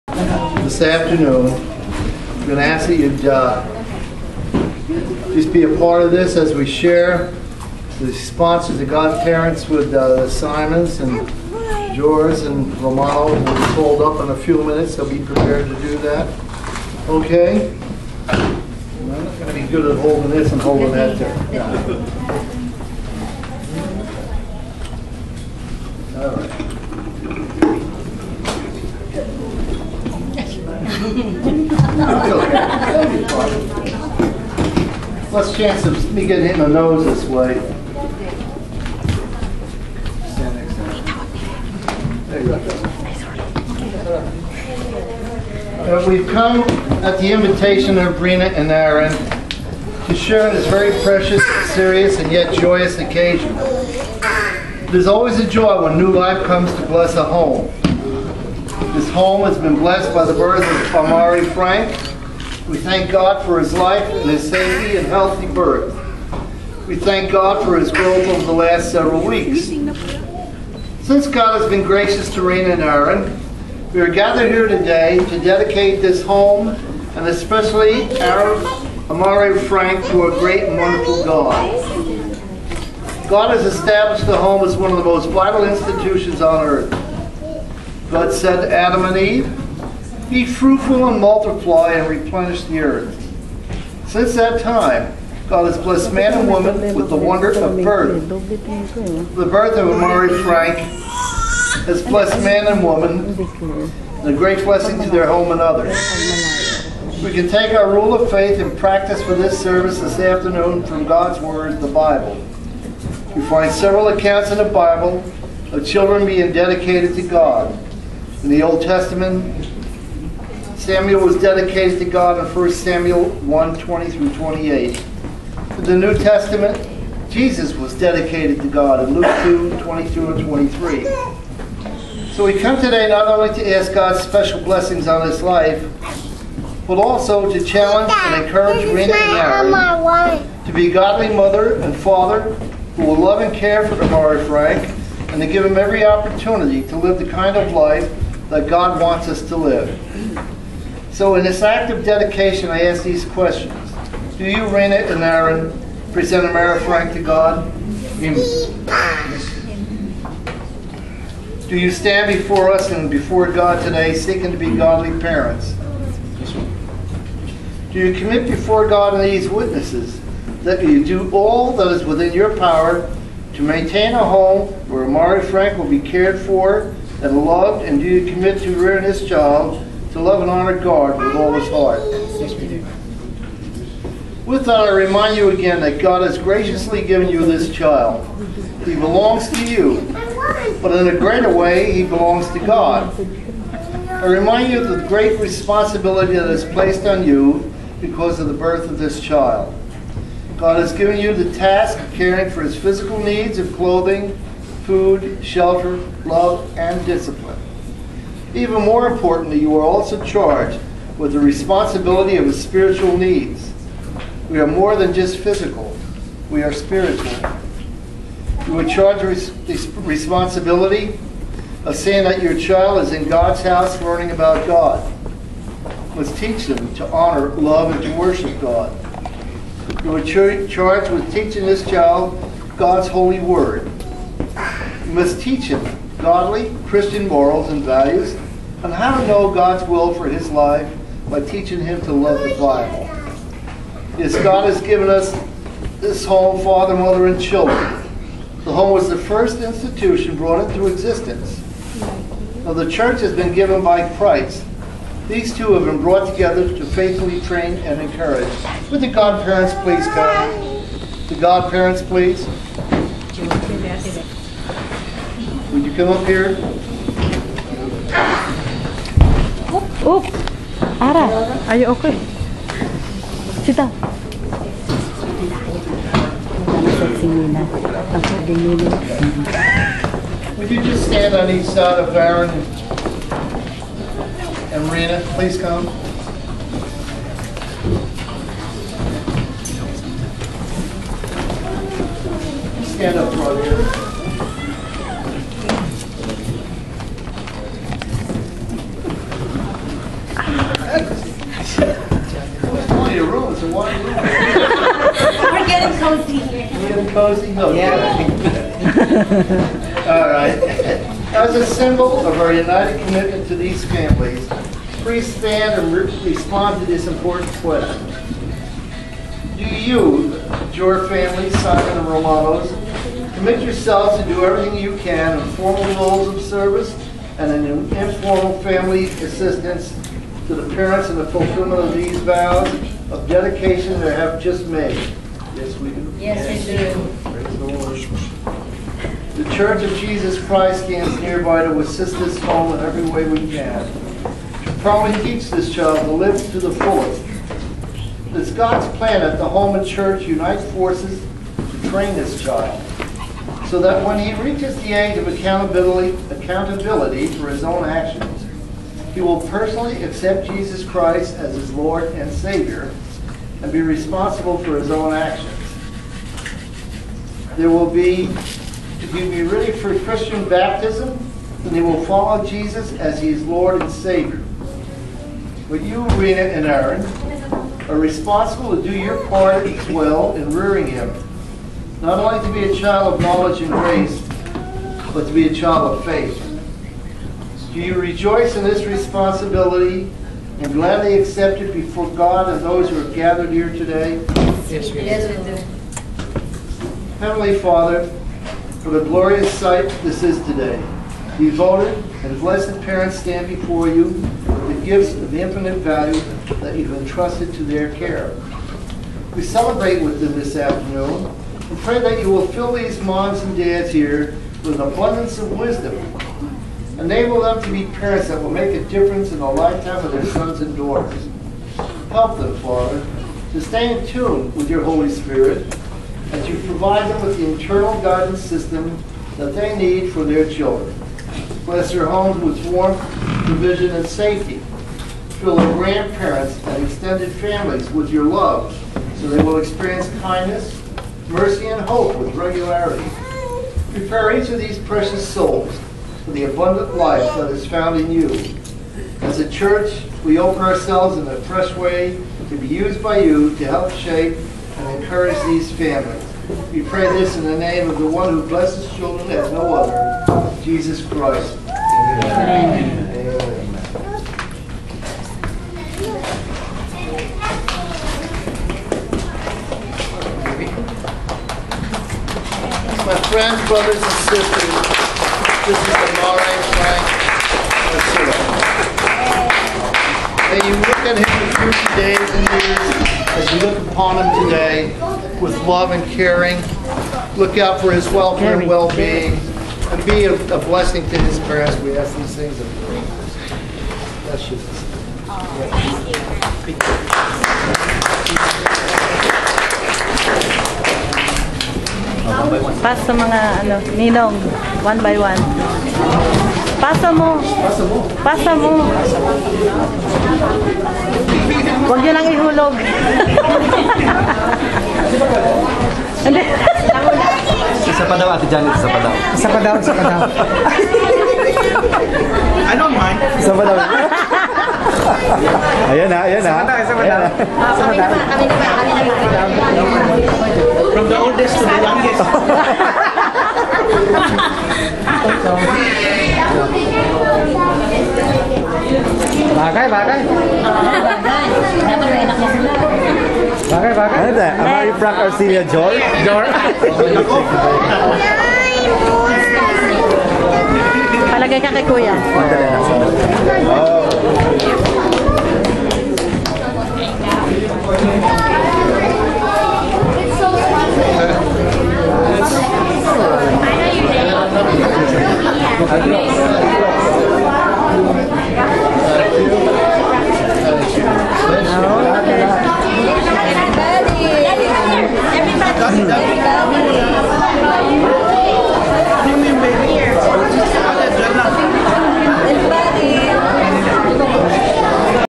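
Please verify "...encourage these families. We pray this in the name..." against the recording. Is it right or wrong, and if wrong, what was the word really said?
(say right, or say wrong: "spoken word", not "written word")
right.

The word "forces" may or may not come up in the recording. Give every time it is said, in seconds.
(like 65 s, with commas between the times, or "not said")
350 s.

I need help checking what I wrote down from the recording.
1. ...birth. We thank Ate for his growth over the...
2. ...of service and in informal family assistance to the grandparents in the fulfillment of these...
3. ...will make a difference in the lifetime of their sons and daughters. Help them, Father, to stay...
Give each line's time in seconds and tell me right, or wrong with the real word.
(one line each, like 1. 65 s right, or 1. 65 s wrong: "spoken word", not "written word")
1. 65 s wrong: "God", not "Ate"
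2. 326 s wrong: "parents", not "grandparents"
3. 418 s right.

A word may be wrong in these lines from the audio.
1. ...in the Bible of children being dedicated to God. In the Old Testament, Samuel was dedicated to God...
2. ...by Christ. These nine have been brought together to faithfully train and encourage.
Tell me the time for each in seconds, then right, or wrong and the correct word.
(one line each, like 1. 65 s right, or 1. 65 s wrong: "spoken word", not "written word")
1. 114 s right
2. 253 s wrong: "two", not "nine".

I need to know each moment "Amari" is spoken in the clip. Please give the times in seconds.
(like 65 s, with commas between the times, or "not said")
60 s, 79 s, 99 s, 156 s, 175 s, 544 s.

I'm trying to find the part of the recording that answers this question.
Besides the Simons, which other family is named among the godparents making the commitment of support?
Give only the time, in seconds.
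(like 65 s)
322 s.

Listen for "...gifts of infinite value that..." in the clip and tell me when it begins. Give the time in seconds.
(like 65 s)
404 s.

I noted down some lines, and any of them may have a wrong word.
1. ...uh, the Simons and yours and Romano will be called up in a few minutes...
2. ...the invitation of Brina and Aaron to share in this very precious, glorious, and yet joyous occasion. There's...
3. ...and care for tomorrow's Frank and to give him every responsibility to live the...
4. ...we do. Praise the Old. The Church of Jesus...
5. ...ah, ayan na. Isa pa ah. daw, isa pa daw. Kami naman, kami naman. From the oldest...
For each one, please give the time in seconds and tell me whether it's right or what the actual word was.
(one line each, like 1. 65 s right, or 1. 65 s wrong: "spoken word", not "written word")
1. 9 s right
2. 47 s wrong: "serious", not "glorious"
3. 143 s wrong: "opportunity", not "responsibility"
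4. 337 s wrong: "Lord", not "Old"
5. 526 s right.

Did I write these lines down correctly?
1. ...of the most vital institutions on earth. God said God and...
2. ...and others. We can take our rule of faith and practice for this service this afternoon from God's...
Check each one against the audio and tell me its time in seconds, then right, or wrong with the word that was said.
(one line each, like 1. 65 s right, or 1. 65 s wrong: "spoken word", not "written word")
1. 84 s wrong: "Adam", not "God"
2. 105 s right.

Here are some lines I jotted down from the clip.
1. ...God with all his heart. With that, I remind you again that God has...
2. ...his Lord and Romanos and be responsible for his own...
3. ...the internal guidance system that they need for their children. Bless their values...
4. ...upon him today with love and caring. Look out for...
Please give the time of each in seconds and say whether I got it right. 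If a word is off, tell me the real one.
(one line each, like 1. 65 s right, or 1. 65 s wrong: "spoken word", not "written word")
1. 180 s right
2. 361 s wrong: "Savior", not "Romanos"
3. 427 s wrong: "homes", not "values"
4. 483 s right.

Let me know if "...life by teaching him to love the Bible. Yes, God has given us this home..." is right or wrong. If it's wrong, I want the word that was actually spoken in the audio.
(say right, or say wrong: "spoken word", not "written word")
right.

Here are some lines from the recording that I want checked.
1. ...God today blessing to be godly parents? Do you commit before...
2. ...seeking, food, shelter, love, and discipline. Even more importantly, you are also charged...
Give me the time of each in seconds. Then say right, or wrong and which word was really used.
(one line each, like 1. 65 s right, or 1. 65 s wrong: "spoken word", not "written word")
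1. 163 s wrong: "seeking", not "blessing"
2. 203 s wrong: "clothing", not "seeking".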